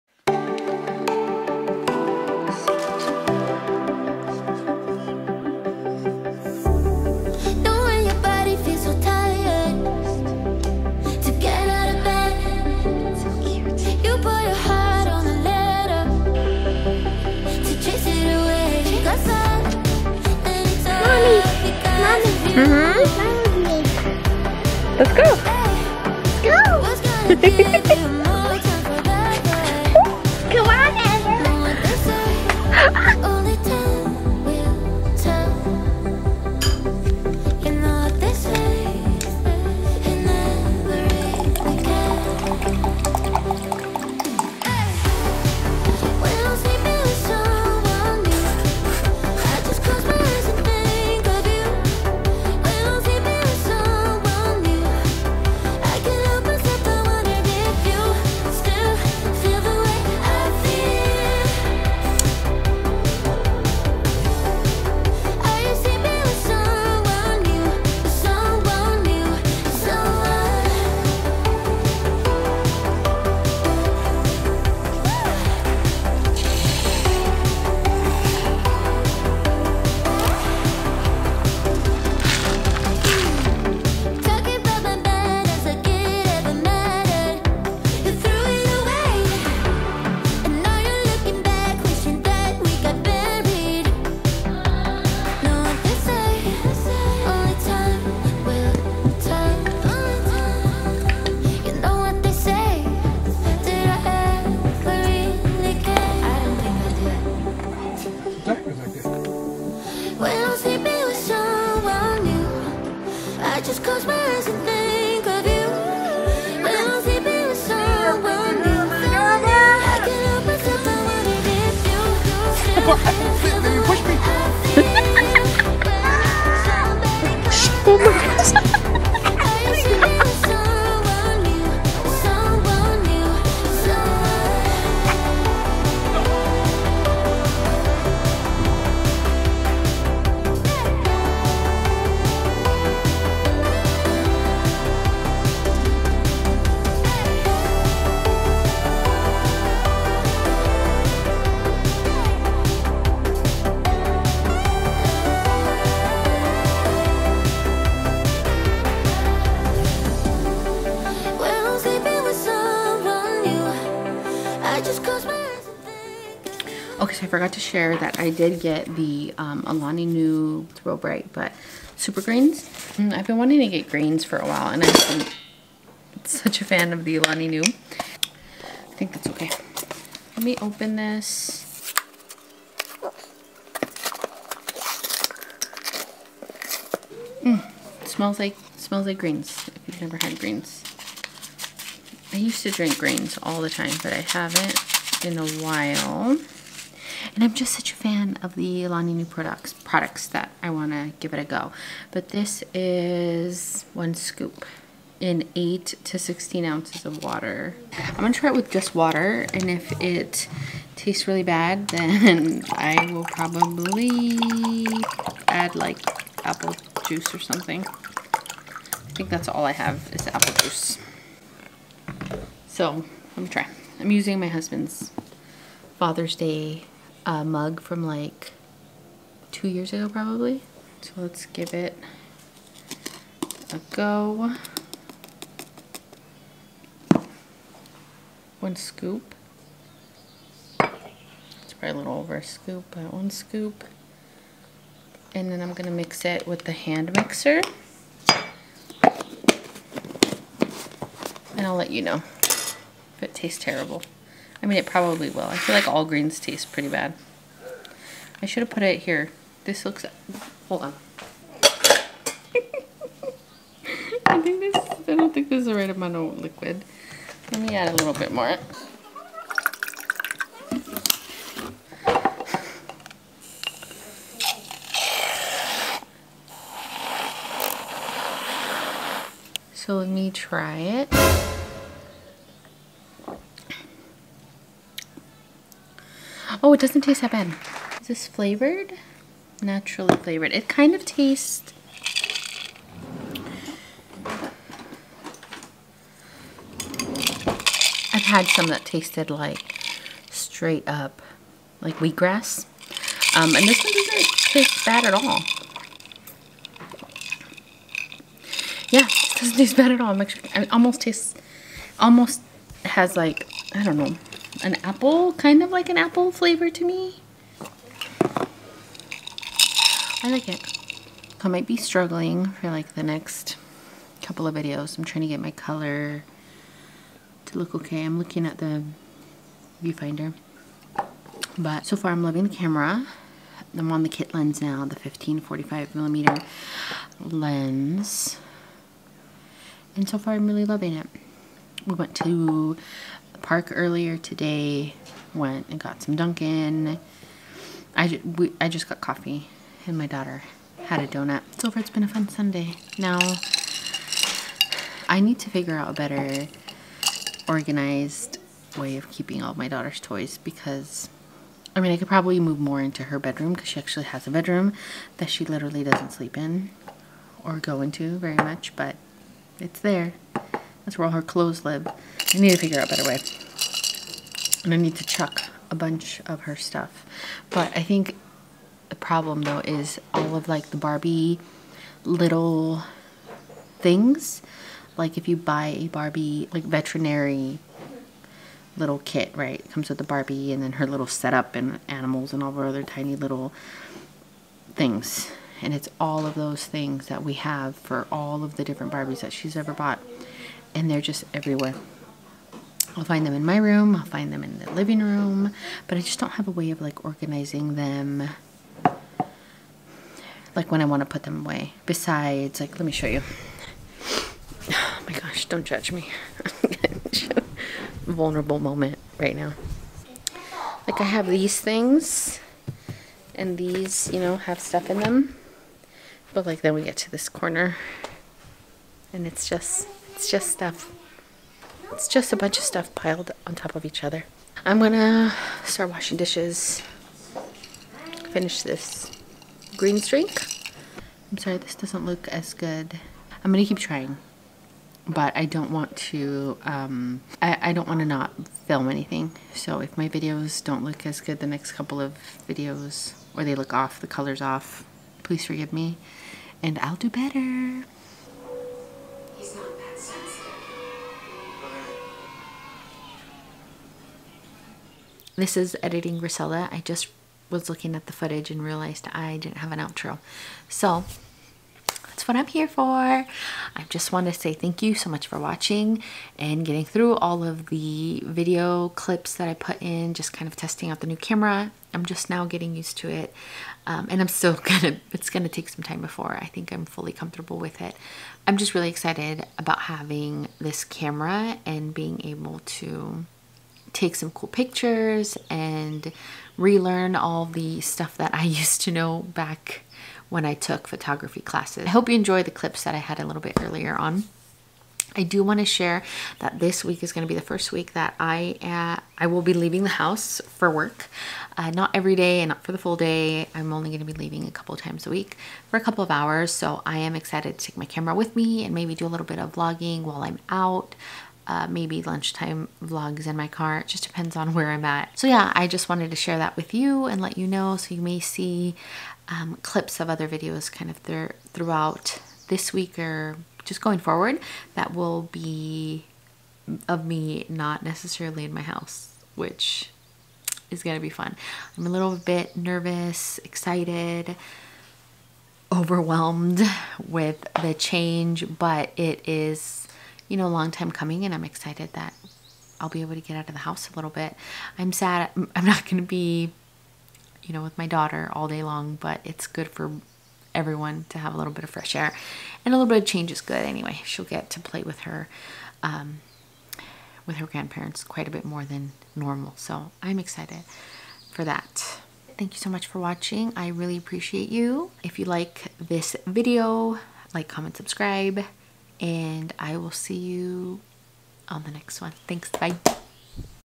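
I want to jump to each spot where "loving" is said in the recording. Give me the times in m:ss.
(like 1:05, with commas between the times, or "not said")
5:32, 5:40.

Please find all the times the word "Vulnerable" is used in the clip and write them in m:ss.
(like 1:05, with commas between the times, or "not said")
6:58.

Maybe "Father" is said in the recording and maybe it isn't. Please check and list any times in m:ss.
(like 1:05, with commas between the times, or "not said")
3:45.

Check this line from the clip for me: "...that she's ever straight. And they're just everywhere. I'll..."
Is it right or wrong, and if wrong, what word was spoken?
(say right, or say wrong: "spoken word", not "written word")
wrong: "bought", not "straight".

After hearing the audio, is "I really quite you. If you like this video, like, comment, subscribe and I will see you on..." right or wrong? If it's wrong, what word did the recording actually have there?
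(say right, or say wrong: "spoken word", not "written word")
wrong: "appreciate", not "quite".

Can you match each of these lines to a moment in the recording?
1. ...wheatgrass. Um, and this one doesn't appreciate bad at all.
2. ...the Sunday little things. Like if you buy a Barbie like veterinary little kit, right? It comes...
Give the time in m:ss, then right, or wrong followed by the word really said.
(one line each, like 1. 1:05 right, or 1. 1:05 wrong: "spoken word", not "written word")
1. 5:01 wrong: "taste", not "appreciate"
2. 6:20 wrong: "Barbie", not "Sunday".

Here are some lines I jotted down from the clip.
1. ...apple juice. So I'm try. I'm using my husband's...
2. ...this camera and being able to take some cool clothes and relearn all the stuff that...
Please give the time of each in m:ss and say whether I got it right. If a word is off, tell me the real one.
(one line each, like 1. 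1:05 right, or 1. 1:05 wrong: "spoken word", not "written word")
1. 3:40 right
2. 8:10 wrong: "pictures", not "clothes".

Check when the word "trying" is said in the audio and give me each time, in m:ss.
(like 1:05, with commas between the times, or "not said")
5:25, 7:23.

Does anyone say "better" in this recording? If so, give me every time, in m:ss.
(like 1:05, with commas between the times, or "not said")
5:55, 6:12, 7:37.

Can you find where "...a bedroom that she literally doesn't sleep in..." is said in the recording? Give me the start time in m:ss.
6:04.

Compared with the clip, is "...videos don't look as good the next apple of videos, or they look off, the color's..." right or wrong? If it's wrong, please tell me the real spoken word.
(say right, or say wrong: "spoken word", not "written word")
wrong: "couple", not "apple".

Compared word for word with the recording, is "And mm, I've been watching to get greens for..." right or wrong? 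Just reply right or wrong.
wrong.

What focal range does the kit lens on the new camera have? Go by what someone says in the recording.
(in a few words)
15-45 millimeter.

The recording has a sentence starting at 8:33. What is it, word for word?
I'm only going to be leaving a couple times a week for a couple of hours.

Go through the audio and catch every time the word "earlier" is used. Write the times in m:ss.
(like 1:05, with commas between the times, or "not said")
5:43, 8:23.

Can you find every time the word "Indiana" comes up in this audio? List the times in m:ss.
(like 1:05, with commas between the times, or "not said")
not said.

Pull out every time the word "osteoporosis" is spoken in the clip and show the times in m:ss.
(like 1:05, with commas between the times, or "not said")
not said.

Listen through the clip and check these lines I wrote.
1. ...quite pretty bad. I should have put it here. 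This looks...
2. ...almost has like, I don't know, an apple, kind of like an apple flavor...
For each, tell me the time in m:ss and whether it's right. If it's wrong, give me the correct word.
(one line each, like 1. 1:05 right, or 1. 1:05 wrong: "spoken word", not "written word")
1. 4:16 wrong: "taste", not "quite"
2. 5:11 right.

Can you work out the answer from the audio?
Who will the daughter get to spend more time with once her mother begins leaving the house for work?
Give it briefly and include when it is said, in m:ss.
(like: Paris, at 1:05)
her grandparents, at 9:27.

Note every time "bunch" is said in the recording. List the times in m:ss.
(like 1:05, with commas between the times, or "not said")
6:15, 7:12.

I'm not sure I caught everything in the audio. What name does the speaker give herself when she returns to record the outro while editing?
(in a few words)
Griselda.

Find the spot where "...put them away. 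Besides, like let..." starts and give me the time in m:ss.
6:51.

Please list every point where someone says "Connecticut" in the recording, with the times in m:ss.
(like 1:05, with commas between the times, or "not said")
not said.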